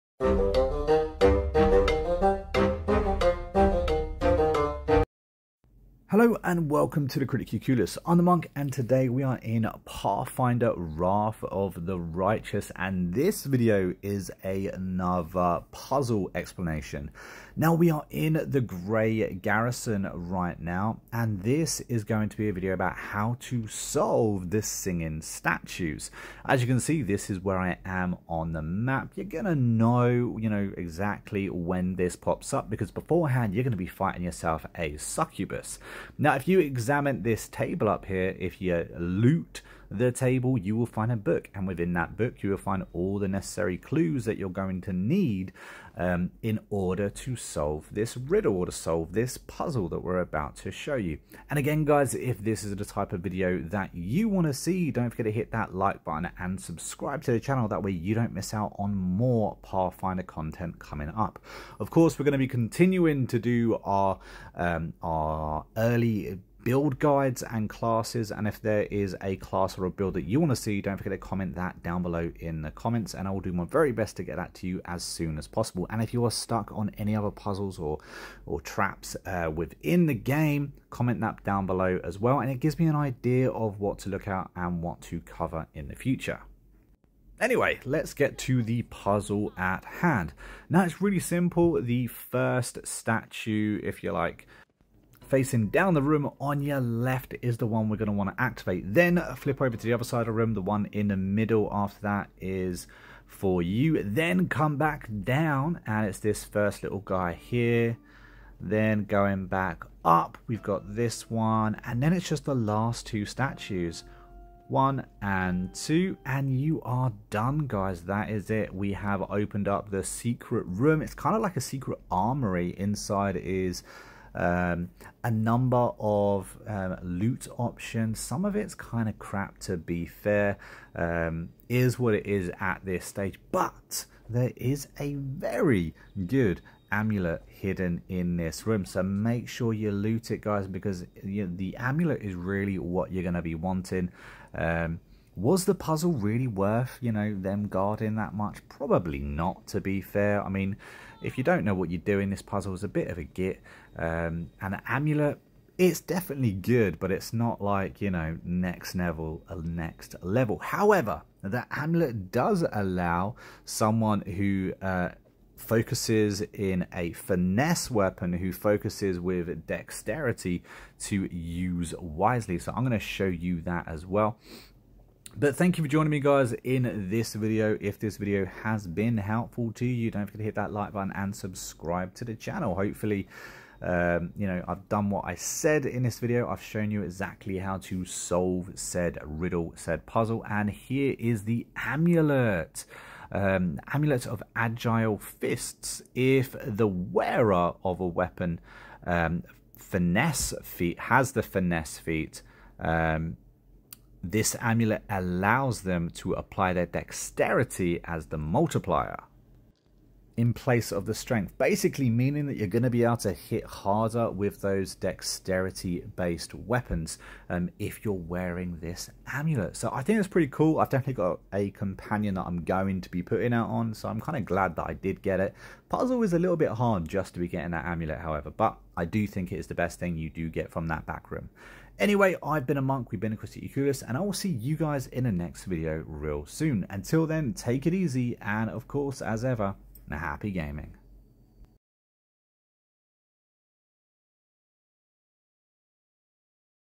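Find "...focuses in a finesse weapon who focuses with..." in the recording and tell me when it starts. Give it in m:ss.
2:45.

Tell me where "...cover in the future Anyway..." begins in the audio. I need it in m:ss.
1:25.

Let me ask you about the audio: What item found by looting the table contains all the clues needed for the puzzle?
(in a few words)
A book.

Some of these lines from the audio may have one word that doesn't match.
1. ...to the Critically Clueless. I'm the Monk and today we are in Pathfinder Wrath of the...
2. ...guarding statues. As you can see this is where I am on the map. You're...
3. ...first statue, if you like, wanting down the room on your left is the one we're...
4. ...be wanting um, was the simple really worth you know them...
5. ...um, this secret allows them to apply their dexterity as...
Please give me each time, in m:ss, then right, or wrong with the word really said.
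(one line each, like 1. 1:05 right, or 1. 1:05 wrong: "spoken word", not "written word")
1. 0:07 right
2. 0:24 wrong: "singing", not "guarding"
3. 1:32 wrong: "facing", not "wanting"
4. 2:23 wrong: "puzzle", not "simple"
5. 3:22 wrong: "amulet", not "secret".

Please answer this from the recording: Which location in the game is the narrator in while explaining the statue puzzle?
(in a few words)
Grey Garrison.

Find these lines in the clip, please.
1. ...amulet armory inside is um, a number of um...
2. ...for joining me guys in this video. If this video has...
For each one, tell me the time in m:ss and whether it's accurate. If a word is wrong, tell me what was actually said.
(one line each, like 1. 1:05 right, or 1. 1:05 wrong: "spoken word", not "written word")
1. 2:01 wrong: "secret", not "amulet"
2. 2:55 right.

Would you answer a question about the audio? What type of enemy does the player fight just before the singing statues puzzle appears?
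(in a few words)
Succubus.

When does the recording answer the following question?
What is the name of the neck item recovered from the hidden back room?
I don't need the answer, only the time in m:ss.
3:13.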